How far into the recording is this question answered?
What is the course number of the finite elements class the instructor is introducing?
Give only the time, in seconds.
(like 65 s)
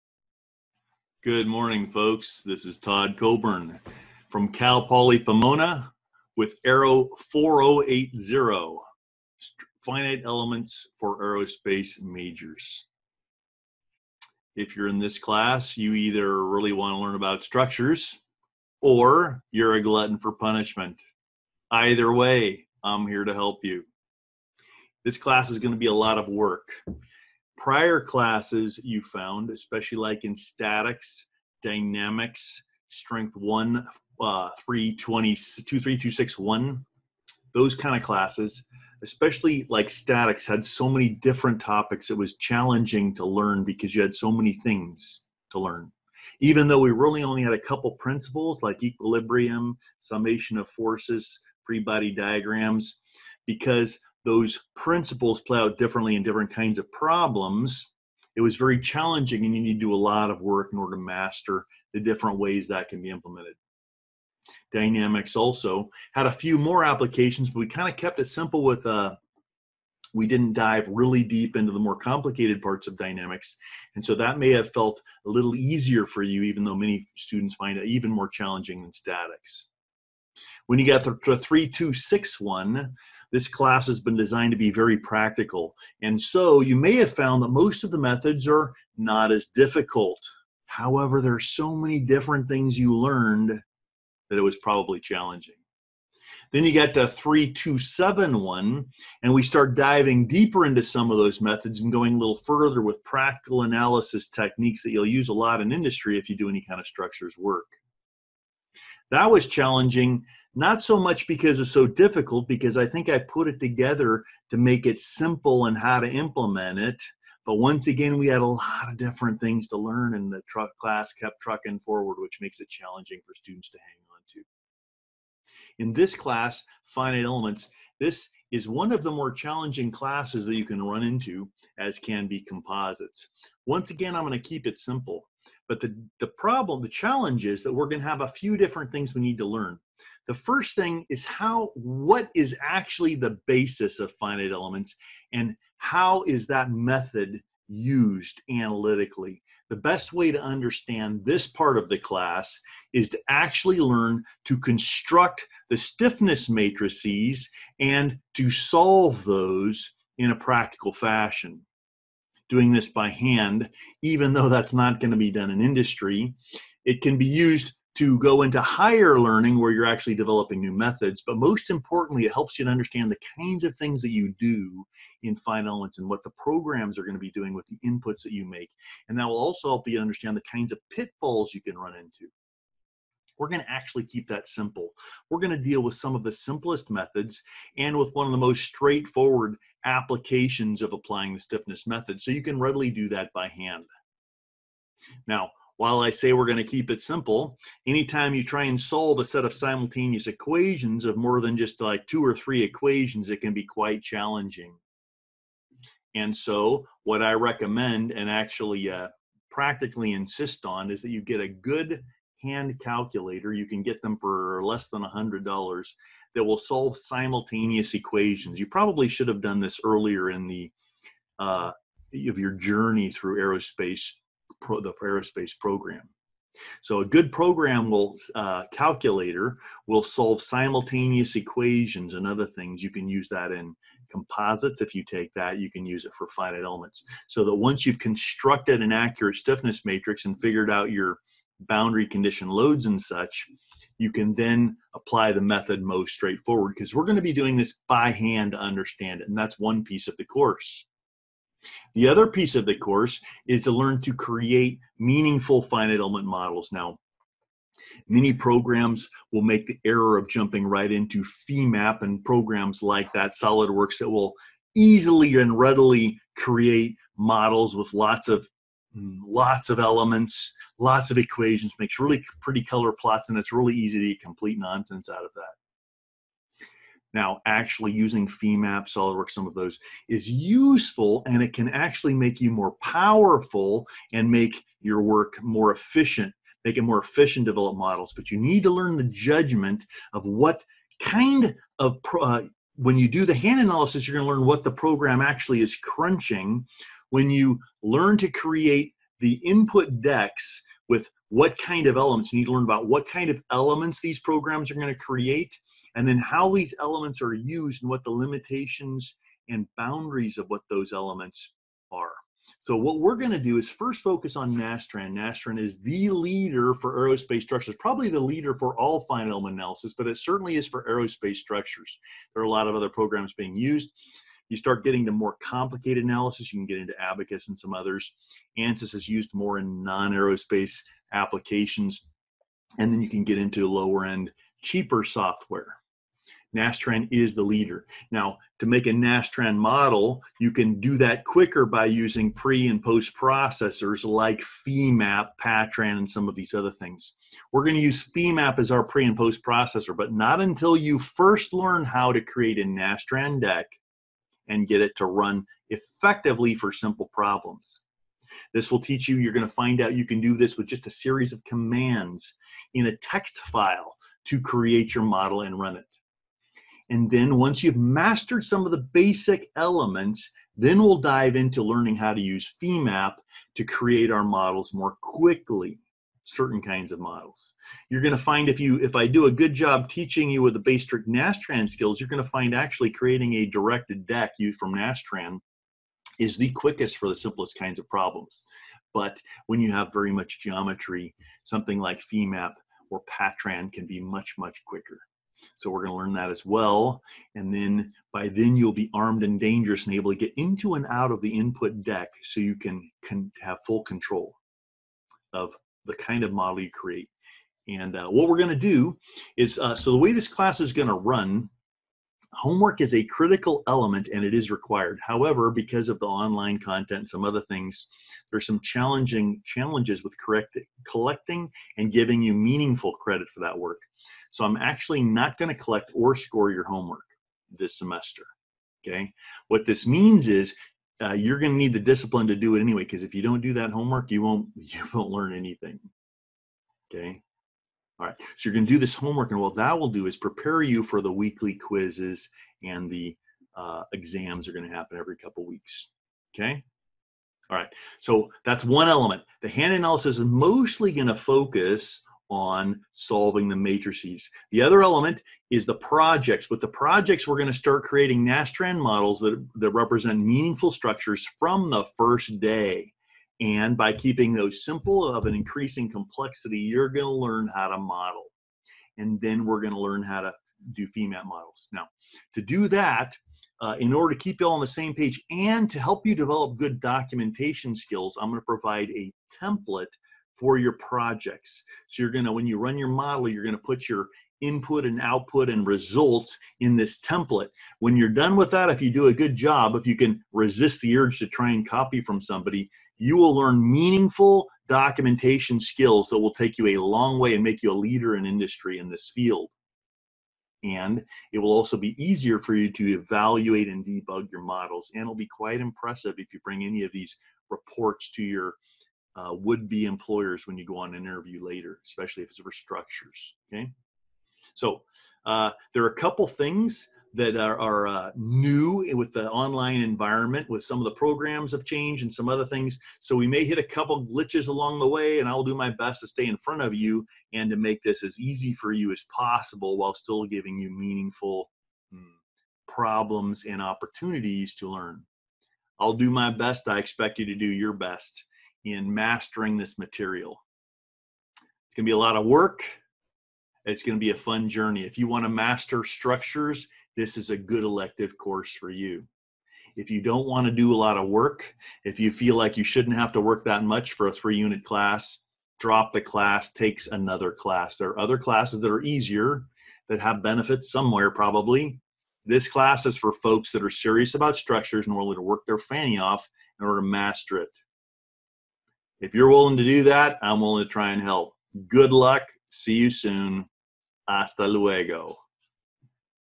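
6 s.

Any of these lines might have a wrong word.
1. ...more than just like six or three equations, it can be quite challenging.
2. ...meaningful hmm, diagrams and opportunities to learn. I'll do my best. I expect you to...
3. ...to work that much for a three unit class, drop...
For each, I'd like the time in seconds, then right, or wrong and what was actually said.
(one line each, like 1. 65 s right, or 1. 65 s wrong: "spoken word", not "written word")
1. 201 s wrong: "two", not "six"
2. 530 s wrong: "problems", not "diagrams"
3. 553 s right.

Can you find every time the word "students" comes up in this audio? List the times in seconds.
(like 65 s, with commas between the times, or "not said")
77 s, 123 s.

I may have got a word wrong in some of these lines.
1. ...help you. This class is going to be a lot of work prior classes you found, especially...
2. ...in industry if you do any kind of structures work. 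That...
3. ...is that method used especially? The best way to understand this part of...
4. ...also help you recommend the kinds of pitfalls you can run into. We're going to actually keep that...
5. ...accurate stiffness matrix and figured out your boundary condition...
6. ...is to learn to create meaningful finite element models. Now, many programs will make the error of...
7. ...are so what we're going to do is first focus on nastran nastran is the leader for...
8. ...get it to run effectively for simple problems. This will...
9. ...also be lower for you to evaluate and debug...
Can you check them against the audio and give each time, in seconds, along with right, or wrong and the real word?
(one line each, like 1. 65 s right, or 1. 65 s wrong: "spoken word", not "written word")
1. 23 s right
2. 105 s right
3. 146 s wrong: "analytically", not "especially"
4. 179 s wrong: "understand", not "recommend"
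5. 238 s right
6. 253 s right
7. 311 s right
8. 354 s right
9. 501 s wrong: "easier", not "lower".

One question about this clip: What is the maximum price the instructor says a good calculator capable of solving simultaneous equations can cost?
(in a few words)
$100.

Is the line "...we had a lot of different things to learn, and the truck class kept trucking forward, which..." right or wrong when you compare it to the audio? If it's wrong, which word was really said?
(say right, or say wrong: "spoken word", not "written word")
right.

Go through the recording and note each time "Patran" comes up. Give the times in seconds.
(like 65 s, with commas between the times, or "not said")
345 s, 393 s.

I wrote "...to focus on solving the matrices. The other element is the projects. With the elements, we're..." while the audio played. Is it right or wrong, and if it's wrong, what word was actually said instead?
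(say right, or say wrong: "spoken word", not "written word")
wrong: "projects", not "elements".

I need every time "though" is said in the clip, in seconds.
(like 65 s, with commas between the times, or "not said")
46 s, 76 s, 164 s.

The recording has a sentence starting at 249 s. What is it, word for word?
And that's one piece of the course.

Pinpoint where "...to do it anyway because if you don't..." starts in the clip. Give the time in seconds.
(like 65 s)
432 s.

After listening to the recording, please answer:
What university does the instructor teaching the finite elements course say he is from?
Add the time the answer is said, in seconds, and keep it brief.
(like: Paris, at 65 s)
Cal Poly Pomona, at 4 s.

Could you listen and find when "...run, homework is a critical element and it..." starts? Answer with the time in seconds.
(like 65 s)
410 s.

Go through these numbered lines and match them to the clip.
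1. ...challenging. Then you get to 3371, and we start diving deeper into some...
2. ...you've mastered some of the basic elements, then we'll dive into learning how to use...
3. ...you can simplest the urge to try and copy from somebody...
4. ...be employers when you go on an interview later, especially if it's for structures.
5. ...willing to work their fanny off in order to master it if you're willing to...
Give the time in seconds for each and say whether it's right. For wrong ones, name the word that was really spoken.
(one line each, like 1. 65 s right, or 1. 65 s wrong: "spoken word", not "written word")
1. 94 s wrong: "3271", not "3371"
2. 367 s right
3. 489 s wrong: "resist", not "simplest"
4. 509 s right
5. 564 s right.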